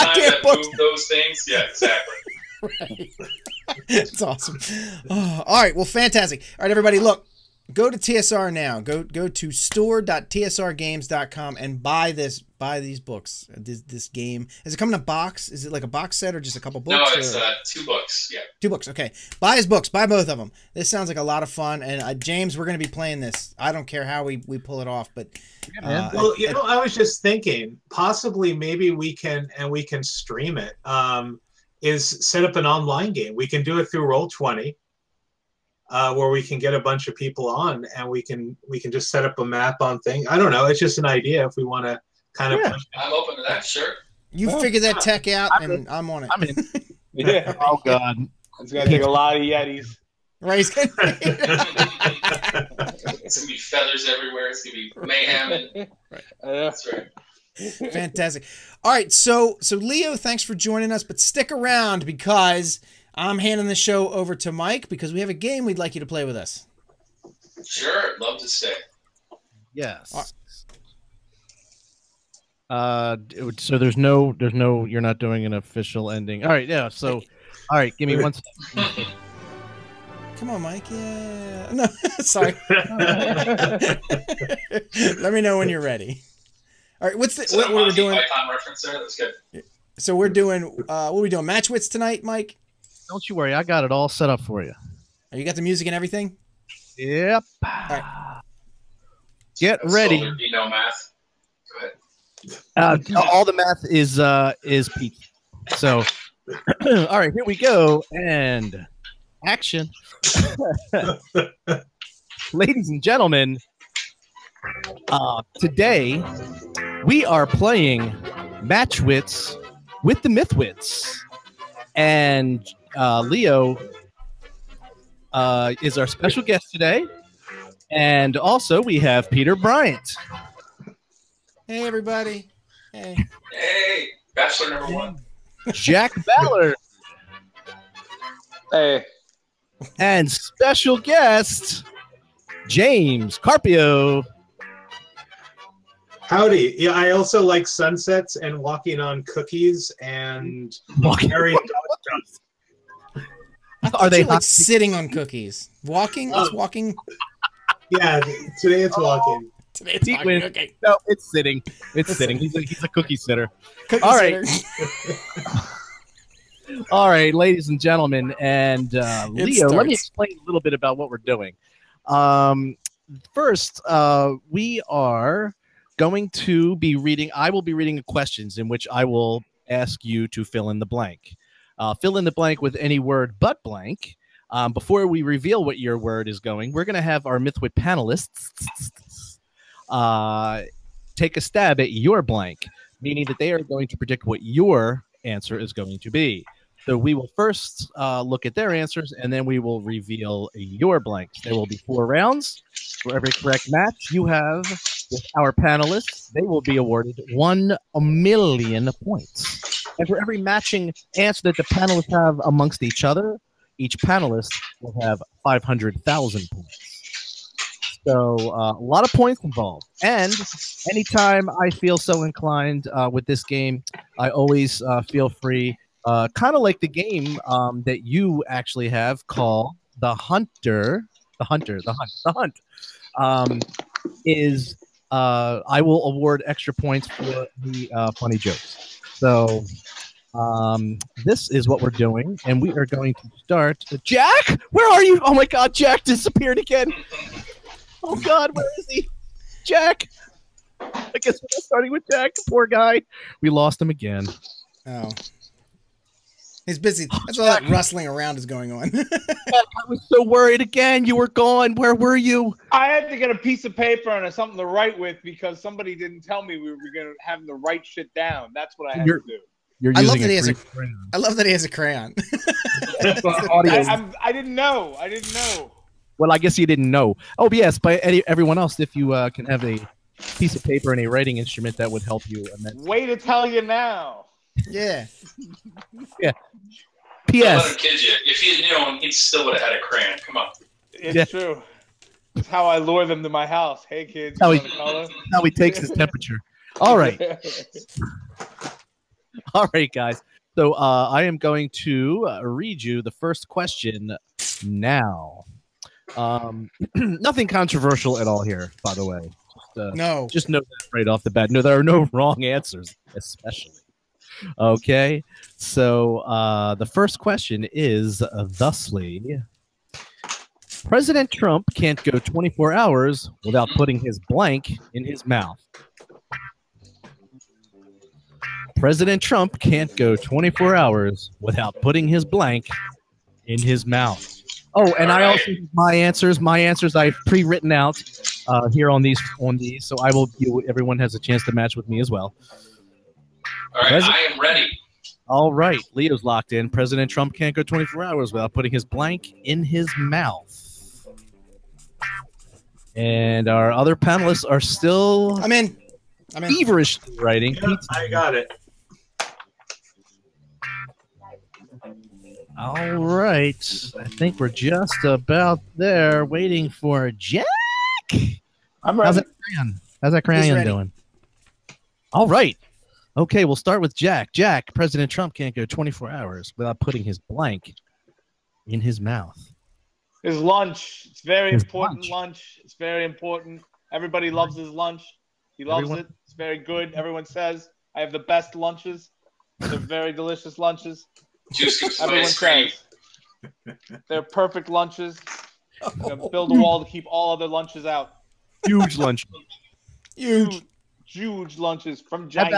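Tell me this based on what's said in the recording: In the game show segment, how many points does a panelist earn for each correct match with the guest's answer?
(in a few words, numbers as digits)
1 million.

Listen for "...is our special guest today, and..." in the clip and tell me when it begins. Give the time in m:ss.
2:05.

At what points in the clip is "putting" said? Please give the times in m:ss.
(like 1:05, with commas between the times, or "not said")
5:23, 5:31, 5:48, 6:16.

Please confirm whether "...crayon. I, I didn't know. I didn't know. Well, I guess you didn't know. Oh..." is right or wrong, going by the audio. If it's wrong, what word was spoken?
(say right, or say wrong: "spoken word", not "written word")
right.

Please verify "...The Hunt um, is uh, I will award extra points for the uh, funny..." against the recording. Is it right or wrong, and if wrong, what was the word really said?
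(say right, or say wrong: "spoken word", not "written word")
right.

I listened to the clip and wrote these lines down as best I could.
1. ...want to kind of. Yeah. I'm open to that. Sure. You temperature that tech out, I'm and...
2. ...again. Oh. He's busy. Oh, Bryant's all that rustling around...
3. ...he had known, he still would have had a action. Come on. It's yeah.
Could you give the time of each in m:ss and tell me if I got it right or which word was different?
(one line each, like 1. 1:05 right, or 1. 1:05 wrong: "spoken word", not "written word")
1. 0:41 wrong: "figure", not "temperature"
2. 4:13 wrong: "That", not "Bryant"
3. 4:48 wrong: "crayon", not "action".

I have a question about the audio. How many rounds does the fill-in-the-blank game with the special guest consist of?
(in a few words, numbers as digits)
4.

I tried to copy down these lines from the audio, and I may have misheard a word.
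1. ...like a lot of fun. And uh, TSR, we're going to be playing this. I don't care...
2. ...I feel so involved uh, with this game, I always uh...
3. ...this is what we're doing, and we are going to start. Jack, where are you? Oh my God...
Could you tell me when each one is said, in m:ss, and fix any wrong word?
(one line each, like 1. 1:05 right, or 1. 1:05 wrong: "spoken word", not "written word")
1. 0:21 wrong: "James", not "TSR"
2. 3:41 wrong: "inclined", not "involved"
3. 4:01 right.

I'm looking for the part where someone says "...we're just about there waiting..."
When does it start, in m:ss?
6:04.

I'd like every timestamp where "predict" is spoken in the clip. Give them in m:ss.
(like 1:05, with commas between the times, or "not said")
3:13.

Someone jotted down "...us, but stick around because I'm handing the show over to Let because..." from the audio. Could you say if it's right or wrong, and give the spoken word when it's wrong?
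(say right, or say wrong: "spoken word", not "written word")
wrong: "Mike", not "Let".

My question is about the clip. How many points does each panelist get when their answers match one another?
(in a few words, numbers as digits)
500,000.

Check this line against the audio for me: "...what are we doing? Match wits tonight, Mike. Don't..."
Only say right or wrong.
right.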